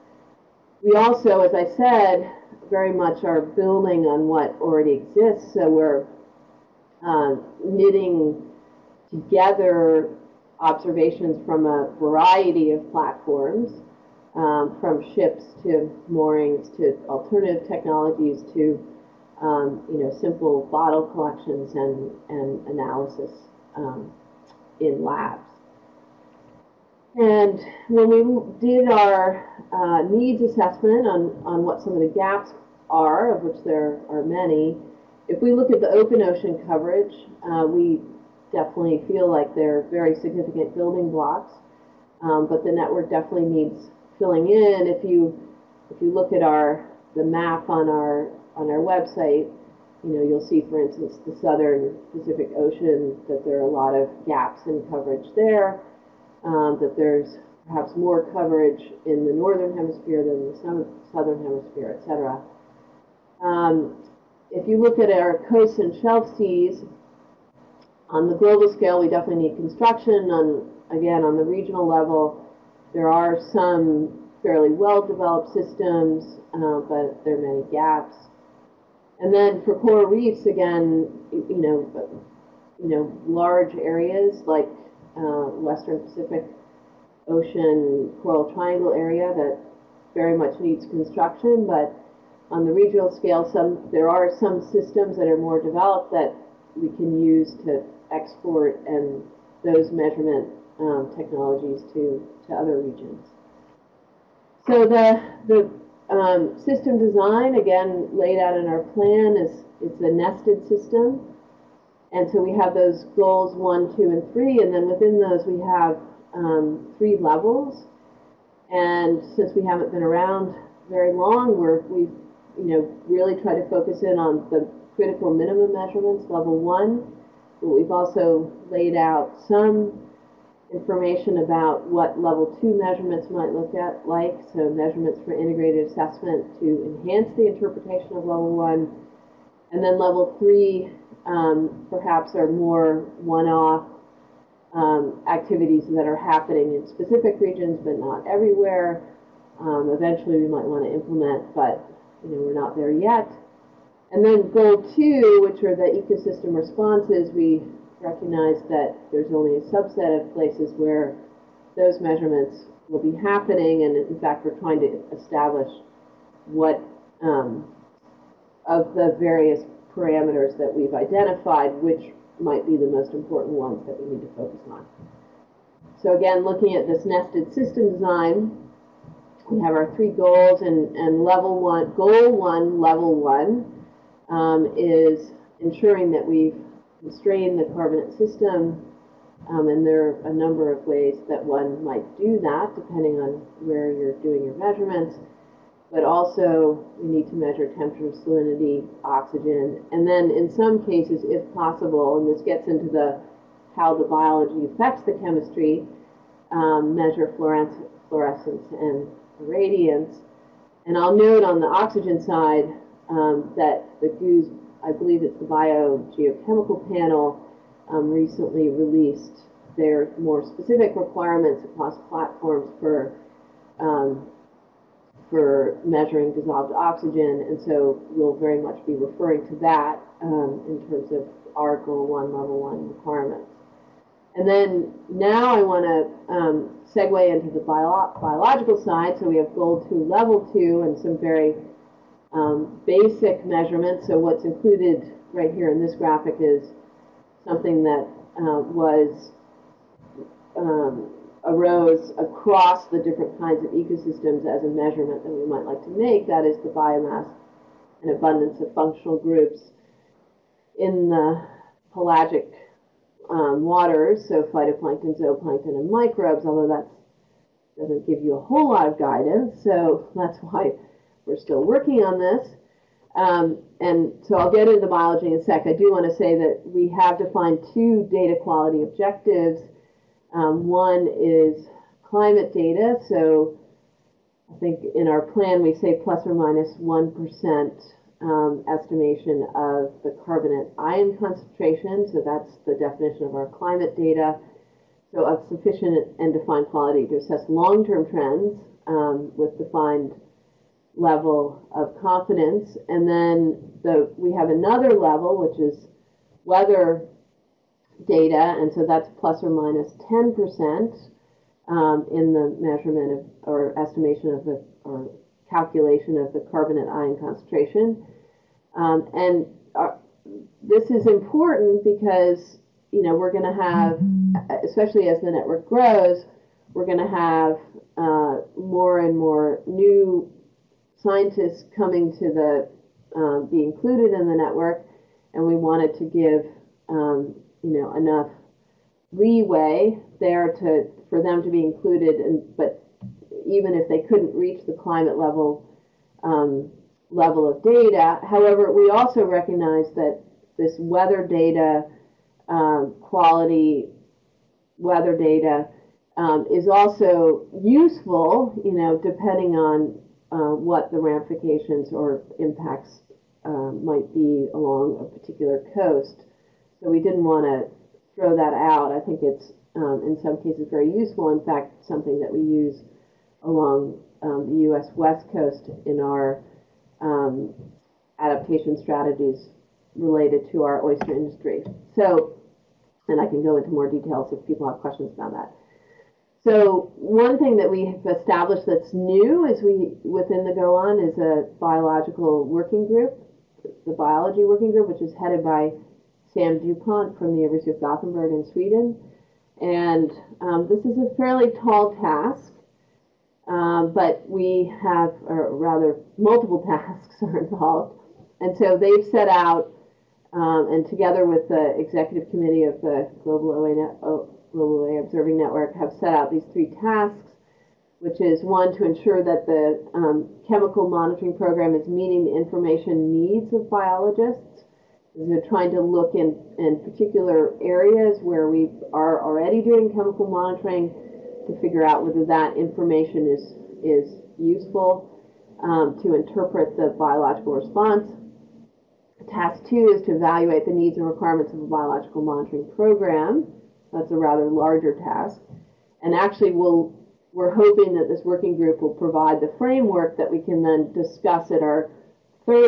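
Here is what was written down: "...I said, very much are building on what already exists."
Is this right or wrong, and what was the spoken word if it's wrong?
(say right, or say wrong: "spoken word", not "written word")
right.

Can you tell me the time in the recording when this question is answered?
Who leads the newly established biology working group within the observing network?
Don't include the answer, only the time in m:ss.
6:36.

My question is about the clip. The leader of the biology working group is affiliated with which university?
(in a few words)
University of Gothenburg.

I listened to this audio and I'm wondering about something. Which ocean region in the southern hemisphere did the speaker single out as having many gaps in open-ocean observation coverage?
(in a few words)
southern Pacific Ocean.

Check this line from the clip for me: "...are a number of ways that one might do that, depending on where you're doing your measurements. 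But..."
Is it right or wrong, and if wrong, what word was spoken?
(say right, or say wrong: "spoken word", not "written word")
right.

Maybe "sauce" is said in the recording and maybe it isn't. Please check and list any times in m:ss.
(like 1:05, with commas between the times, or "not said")
not said.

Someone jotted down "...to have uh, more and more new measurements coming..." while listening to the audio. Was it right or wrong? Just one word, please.
wrong.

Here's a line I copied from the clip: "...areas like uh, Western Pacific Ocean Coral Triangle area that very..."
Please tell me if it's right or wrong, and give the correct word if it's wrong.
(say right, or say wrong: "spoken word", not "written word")
right.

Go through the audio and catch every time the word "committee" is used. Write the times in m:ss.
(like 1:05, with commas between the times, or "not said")
6:52.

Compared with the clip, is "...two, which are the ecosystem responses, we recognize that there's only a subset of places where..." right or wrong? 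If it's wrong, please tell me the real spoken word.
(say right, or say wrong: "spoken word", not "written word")
right.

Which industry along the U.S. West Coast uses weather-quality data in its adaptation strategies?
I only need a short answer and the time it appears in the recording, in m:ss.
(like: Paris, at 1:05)
oyster industry, at 6:20.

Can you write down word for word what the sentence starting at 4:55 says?
So of sufficient and defined quality to assess long-term trends um, with defined level of confidence.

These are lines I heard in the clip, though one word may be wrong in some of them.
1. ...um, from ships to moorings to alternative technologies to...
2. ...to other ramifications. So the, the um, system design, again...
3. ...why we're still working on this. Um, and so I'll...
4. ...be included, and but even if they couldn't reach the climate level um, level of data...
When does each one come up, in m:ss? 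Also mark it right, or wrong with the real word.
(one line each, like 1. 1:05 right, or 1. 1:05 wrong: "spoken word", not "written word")
1. 0:14 right
2. 1:42 wrong: "regions", not "ramifications"
3. 4:30 right
4. 5:41 right.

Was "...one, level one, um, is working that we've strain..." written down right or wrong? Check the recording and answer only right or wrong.
wrong.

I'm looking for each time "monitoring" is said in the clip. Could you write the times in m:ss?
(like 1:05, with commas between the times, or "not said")
7:00, 7:10, 7:22.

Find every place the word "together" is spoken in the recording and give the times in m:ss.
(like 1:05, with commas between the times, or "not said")
0:09, 6:50.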